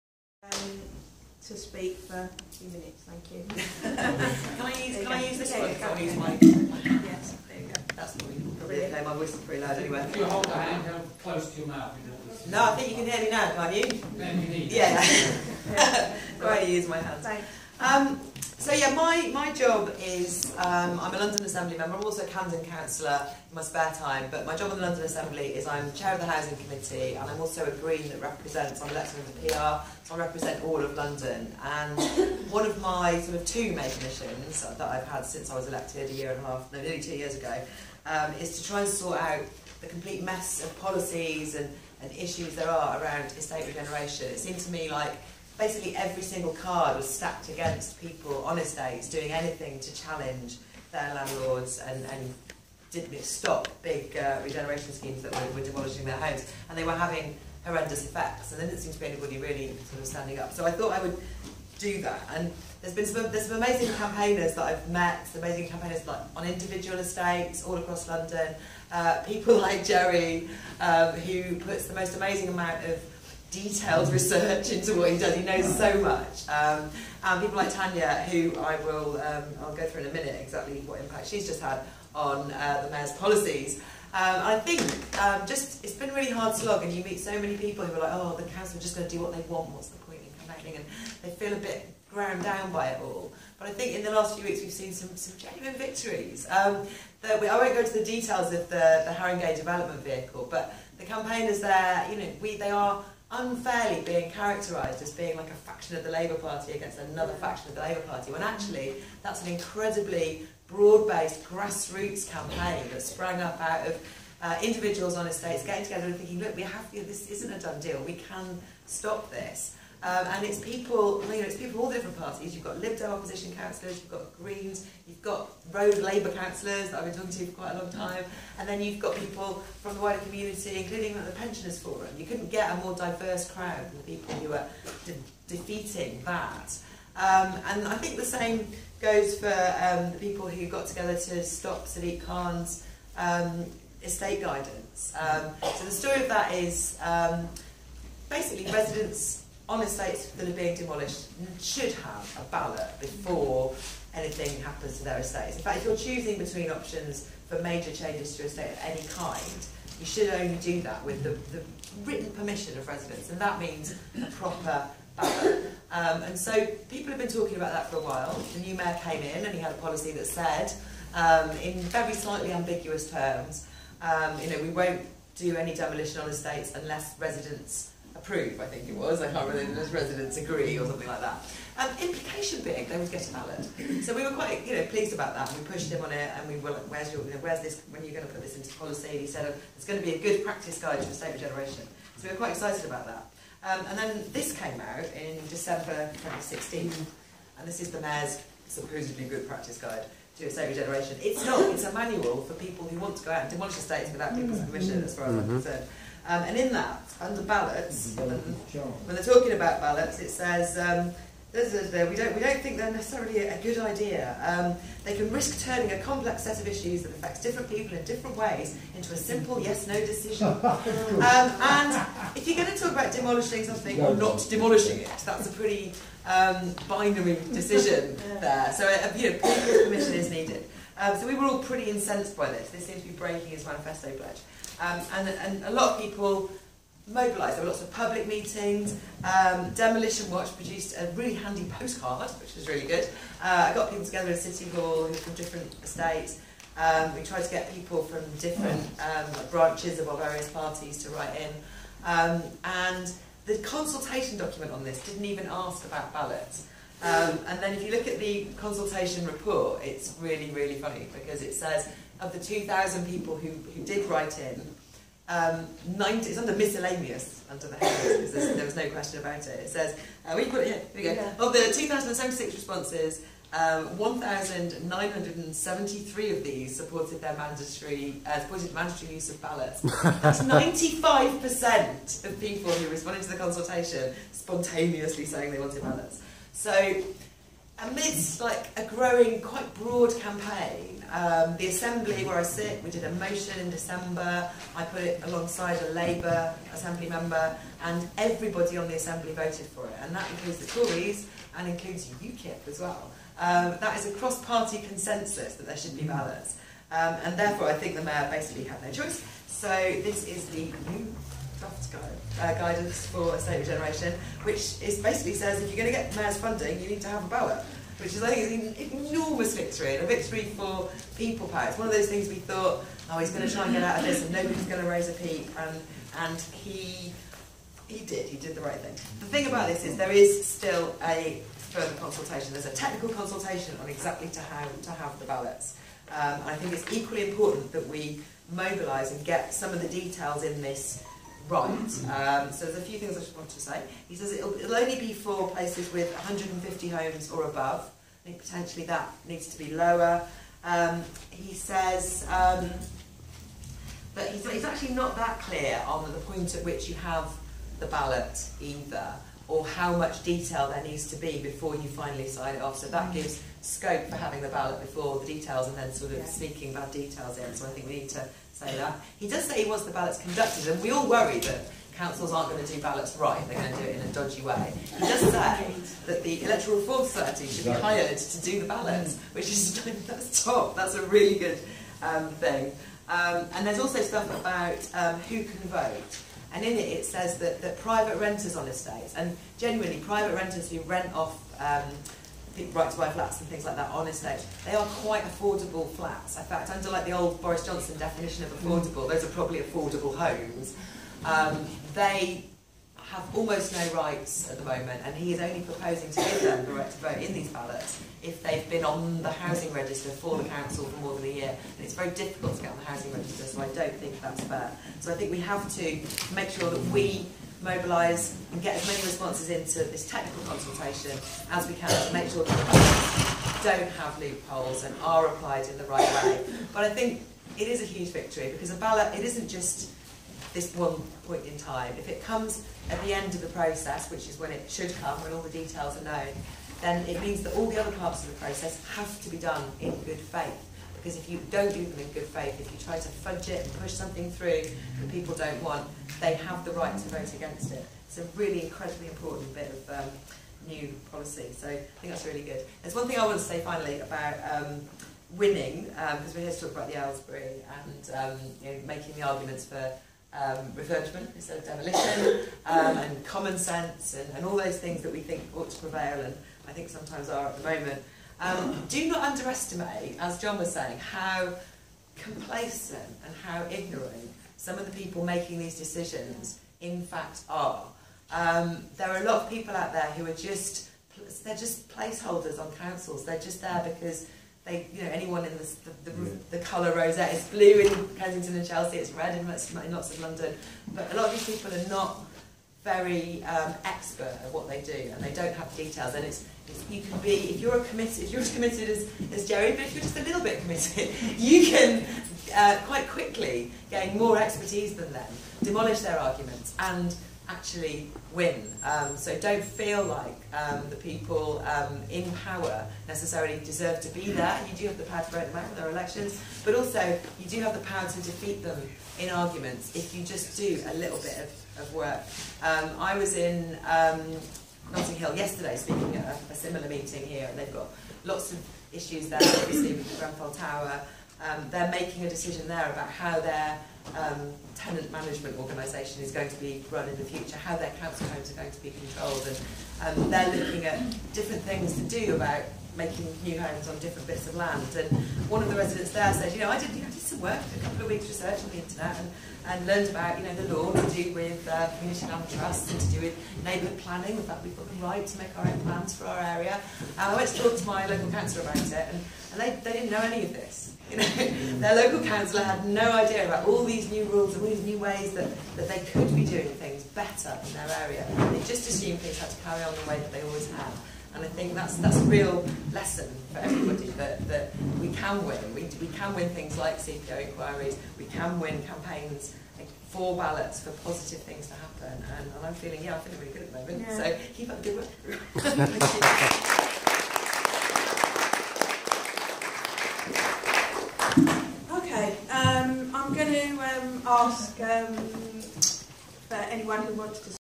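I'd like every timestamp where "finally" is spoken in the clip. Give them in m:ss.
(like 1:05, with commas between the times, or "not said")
6:01, 7:33.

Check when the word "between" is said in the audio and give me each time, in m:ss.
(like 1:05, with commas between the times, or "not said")
2:36.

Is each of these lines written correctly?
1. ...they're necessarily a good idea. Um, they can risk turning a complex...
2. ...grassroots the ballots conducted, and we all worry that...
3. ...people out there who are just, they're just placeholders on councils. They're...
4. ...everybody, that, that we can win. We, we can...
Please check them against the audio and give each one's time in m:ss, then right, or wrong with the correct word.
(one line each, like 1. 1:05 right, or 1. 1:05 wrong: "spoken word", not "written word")
1. 3:32 right
2. 6:09 wrong: "wants", not "grassroots"
3. 7:59 right
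4. 9:33 right.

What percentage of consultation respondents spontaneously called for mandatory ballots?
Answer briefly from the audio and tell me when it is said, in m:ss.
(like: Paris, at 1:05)
95%, at 4:40.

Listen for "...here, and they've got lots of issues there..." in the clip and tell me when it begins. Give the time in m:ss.
8:47.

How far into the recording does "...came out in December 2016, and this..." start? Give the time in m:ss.
3:14.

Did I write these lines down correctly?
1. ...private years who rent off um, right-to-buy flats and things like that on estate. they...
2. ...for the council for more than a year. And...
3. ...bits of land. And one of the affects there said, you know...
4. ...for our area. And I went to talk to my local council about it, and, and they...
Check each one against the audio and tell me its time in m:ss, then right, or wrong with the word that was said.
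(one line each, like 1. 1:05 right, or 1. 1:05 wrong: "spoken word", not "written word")
1. 6:29 wrong: "renters", not "years"
2. 6:50 right
3. 9:04 wrong: "residents", not "affects"
4. 9:16 right.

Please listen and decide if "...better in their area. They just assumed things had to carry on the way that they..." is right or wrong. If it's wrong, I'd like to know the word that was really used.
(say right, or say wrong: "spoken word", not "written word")
right.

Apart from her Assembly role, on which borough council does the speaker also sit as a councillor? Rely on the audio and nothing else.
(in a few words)
Camden.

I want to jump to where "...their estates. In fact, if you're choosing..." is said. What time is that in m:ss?
2:35.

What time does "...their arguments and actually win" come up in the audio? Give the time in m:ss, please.
8:25.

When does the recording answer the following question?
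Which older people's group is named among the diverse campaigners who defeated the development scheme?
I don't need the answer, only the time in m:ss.
2:11.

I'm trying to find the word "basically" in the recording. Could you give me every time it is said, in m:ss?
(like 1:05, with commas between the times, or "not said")
0:45, 2:28, 5:08, 5:15.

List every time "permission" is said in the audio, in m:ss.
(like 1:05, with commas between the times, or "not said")
2:42, 3:24, 3:49.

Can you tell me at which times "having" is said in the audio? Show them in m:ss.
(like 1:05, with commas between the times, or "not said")
0:56, 6:04.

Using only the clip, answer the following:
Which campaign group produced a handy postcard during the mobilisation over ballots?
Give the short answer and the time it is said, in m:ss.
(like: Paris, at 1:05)
Demolition Watch, at 3:59.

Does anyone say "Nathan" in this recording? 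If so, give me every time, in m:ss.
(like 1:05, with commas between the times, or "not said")
not said.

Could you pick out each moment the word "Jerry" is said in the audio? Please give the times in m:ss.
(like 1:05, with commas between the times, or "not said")
1:09, 8:19.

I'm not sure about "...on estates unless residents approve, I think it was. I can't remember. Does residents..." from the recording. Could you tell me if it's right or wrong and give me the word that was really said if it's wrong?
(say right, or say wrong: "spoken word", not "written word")
right.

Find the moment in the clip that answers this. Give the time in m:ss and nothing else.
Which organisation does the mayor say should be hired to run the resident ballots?
6:16.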